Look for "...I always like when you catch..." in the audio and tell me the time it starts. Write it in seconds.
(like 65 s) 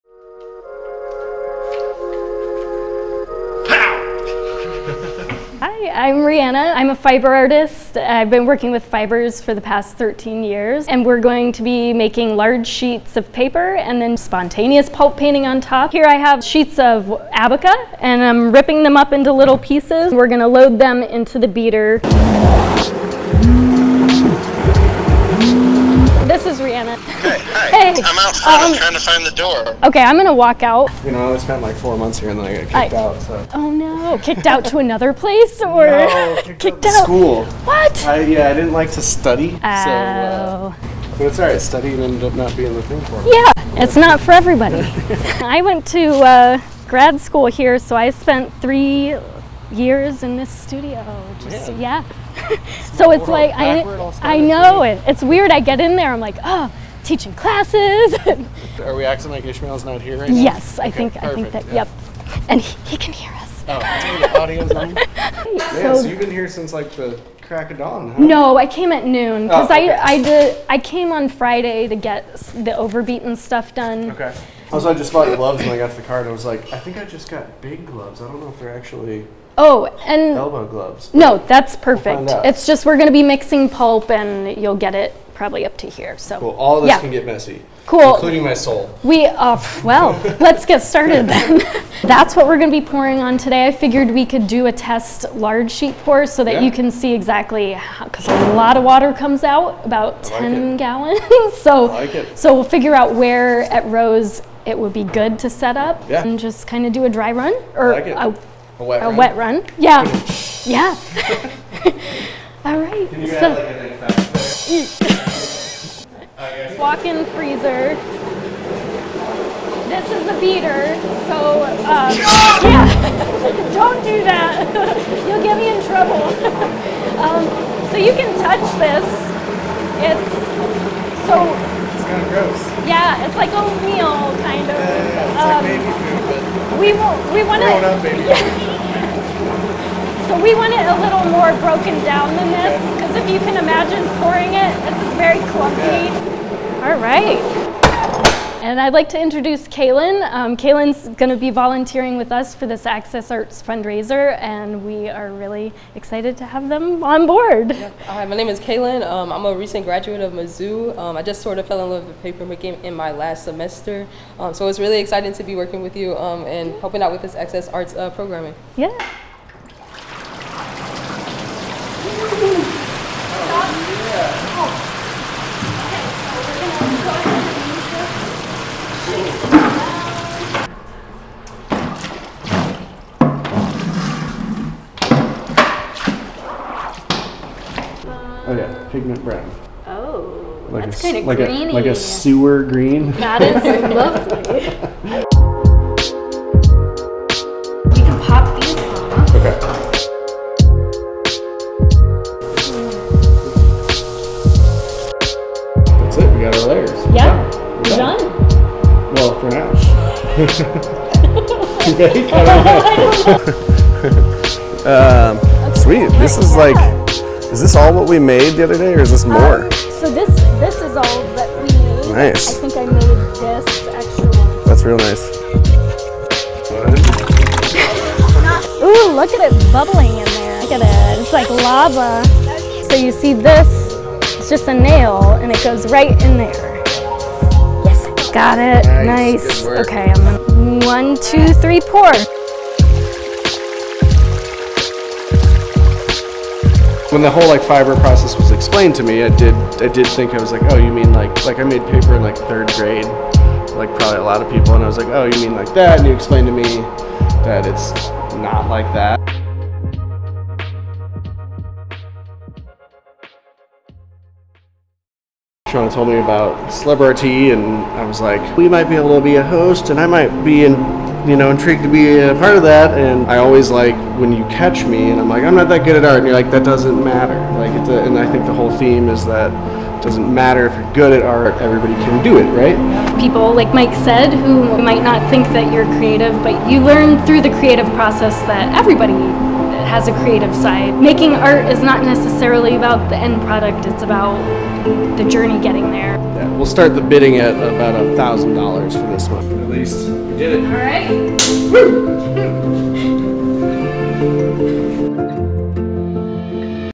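273 s.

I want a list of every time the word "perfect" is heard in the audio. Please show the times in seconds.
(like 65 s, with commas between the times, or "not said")
61 s, 81 s.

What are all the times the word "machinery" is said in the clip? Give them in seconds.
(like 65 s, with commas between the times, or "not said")
not said.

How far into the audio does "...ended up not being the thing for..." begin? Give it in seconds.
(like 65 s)
42 s.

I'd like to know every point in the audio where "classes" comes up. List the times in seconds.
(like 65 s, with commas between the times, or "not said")
57 s.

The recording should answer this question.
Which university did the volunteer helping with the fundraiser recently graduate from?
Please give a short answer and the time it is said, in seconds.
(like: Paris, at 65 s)
Mizzou, at 160 s.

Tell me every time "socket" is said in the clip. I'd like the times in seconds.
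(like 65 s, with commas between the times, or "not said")
not said.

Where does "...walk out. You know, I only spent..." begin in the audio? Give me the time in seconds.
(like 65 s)
30 s.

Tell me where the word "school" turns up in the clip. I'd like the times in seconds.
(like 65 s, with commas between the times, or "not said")
37 s, 47 s.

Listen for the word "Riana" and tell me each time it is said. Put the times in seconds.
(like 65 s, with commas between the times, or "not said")
6 s, 26 s.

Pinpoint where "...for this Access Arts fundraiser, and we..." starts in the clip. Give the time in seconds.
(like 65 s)
152 s.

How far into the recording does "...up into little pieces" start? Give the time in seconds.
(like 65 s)
18 s.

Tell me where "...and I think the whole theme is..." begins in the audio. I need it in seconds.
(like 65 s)
278 s.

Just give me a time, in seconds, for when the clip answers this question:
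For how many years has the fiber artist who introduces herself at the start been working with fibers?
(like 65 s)
9 s.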